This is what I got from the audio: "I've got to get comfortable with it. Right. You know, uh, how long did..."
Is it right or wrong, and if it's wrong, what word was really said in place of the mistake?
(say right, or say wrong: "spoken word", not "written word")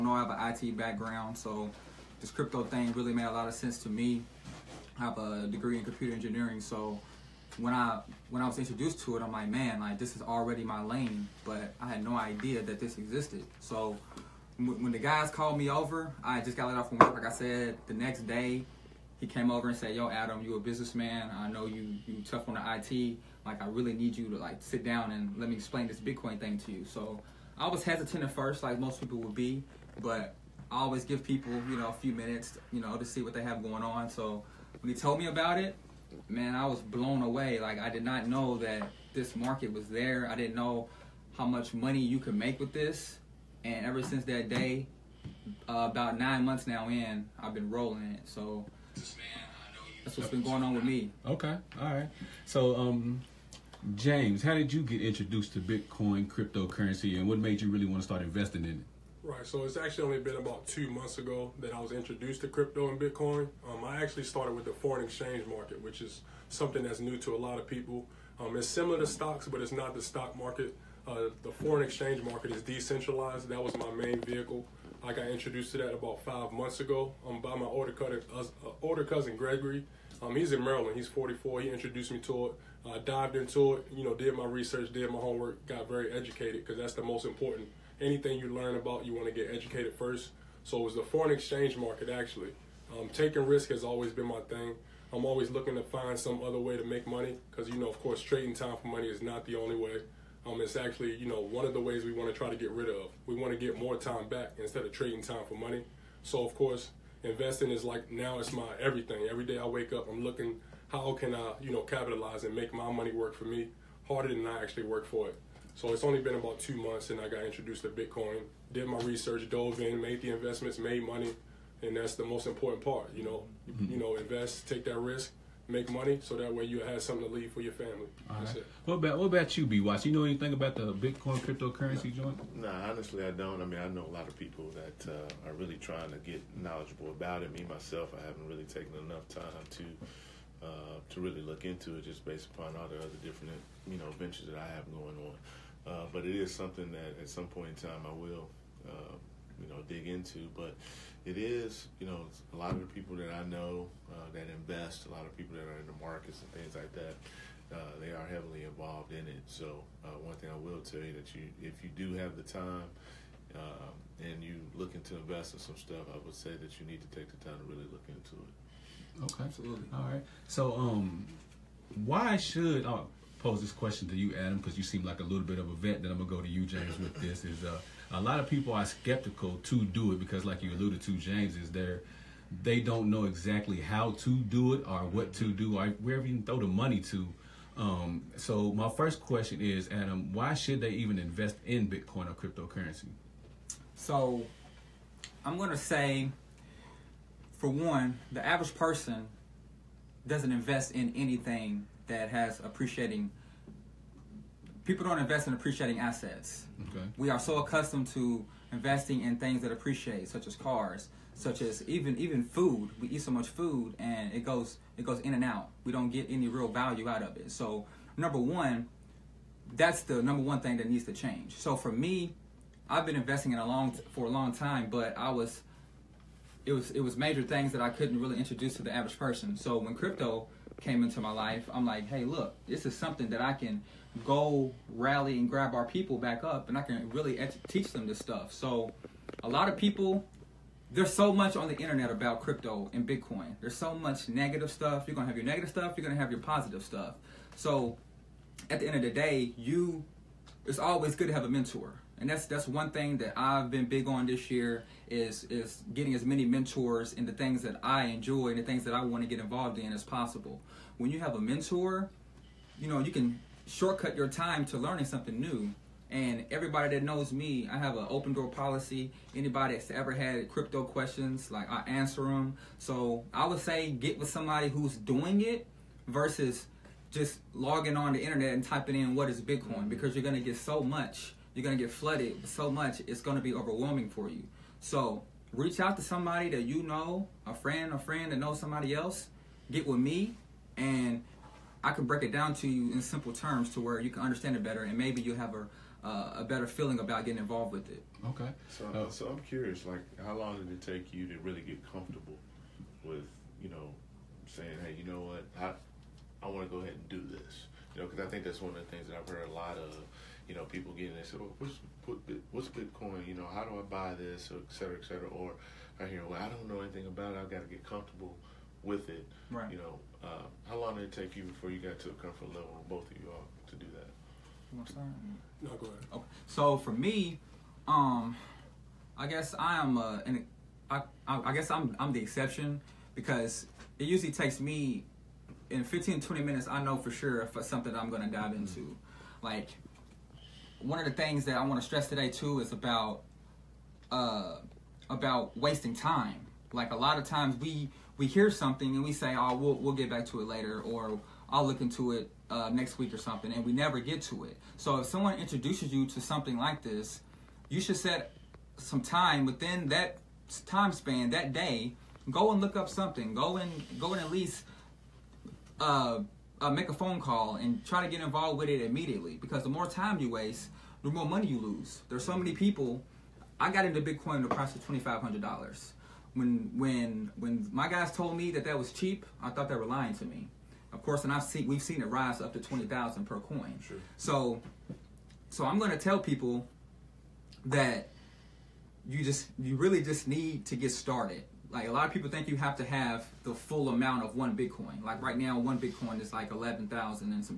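right.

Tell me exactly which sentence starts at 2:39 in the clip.
So uh, one thing I will tell you that you, if you do have the time.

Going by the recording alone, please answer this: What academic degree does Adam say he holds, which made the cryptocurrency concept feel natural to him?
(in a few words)
Computer engineering.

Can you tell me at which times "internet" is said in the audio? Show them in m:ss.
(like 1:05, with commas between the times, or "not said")
4:01, 4:38.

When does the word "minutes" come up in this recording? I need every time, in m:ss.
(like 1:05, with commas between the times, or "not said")
0:32, 5:36.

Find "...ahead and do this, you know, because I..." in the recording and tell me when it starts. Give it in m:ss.
5:06.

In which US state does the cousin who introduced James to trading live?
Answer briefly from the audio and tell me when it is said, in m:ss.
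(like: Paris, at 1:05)
Maryland, at 1:20.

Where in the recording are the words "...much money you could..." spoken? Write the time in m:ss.
0:41.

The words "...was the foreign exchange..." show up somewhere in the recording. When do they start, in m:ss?
1:30.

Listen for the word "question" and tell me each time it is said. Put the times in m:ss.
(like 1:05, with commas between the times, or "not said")
2:53, 3:09, 4:30.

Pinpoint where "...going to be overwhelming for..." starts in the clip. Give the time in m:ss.
4:43.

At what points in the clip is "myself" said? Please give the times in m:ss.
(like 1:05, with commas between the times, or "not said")
2:17.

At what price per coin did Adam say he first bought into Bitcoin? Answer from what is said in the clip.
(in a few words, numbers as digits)
$2,500.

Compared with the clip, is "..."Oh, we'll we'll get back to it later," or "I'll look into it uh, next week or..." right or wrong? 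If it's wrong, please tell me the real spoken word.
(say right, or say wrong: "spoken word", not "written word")
right.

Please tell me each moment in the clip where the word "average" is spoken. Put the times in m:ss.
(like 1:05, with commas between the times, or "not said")
3:18, 3:48.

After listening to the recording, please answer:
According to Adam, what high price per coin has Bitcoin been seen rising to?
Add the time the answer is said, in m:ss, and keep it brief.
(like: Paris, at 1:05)
20,000, at 6:22.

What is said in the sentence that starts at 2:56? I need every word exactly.
Then I'm gonna go to you, James, with this.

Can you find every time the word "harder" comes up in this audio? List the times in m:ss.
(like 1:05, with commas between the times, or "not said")
1:54.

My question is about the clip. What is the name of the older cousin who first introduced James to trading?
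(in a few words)
Gregory.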